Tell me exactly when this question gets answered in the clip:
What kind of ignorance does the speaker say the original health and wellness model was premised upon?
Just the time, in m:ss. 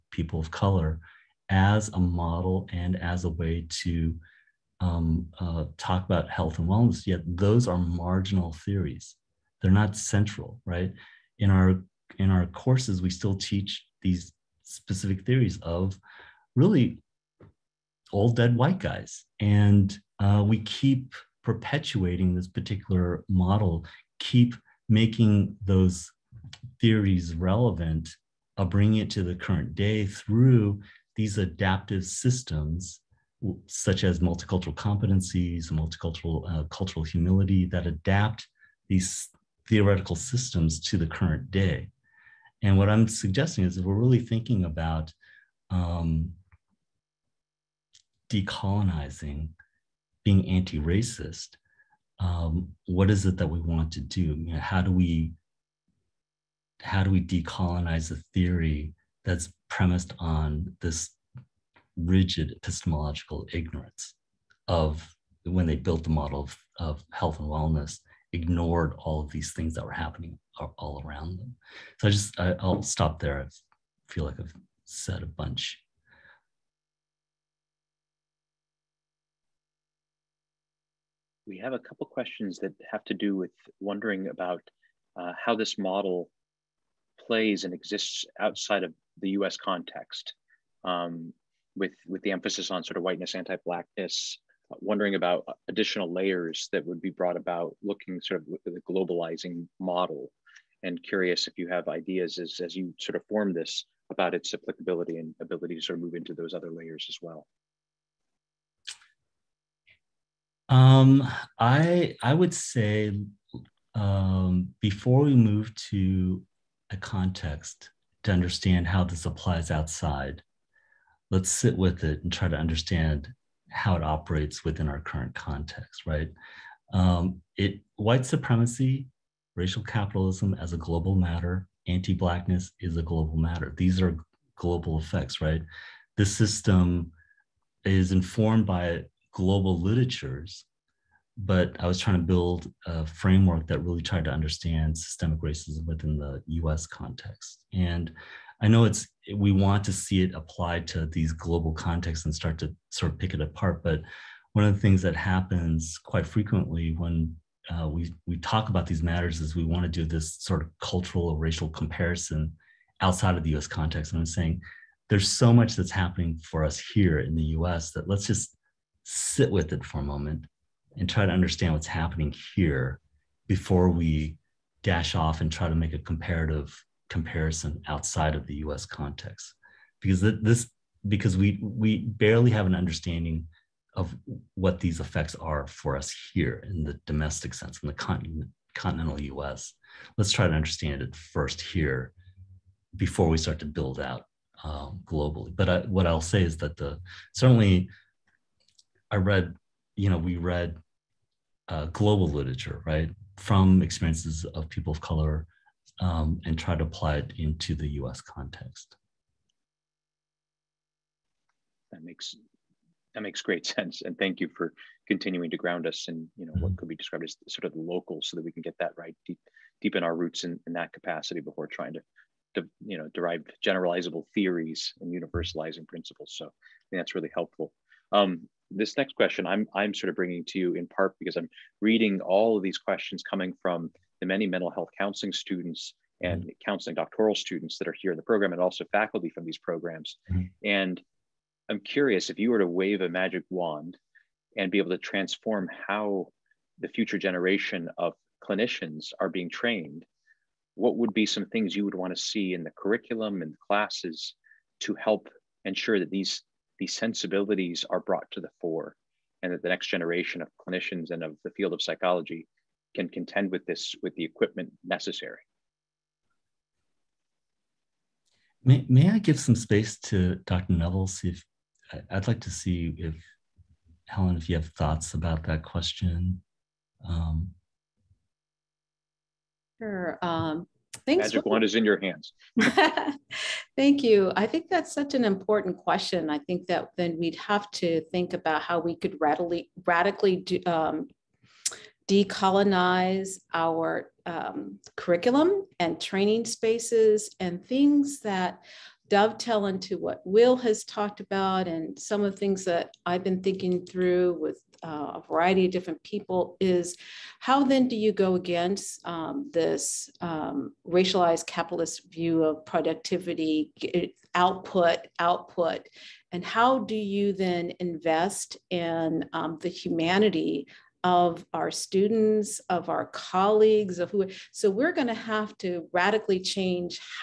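1:01.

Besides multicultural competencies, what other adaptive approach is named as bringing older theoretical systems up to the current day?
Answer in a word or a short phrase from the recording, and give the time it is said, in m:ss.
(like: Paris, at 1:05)
cultural humility, at 0:36.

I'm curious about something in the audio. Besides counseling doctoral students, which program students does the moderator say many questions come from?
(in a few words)
mental health counseling students.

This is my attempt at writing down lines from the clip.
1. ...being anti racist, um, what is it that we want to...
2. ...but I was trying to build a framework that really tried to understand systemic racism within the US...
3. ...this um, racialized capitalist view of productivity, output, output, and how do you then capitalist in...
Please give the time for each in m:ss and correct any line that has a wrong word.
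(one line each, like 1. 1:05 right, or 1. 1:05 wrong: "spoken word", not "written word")
1. 0:50 right
2. 2:21 right
3. 5:09 wrong: "invest", not "capitalist".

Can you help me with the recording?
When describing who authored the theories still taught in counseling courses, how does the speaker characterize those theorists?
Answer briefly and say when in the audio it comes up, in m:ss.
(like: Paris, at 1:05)
dead white guys, at 0:18.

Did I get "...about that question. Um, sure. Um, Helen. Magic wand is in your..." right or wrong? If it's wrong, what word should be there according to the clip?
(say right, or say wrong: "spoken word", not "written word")
wrong: "Thanks", not "Helen".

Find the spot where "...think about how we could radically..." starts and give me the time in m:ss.
4:48.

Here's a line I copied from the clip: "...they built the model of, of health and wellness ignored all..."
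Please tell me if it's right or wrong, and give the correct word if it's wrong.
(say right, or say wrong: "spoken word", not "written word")
right.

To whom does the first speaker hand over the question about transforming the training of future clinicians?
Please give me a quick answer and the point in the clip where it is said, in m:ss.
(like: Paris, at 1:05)
Dr. Neville, at 4:30.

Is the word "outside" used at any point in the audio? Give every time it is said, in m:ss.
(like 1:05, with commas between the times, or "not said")
1:28, 1:59, 2:43, 2:57.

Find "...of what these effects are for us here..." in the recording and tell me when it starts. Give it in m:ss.
3:03.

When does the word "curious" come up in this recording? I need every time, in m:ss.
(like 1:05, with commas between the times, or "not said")
1:41, 4:01.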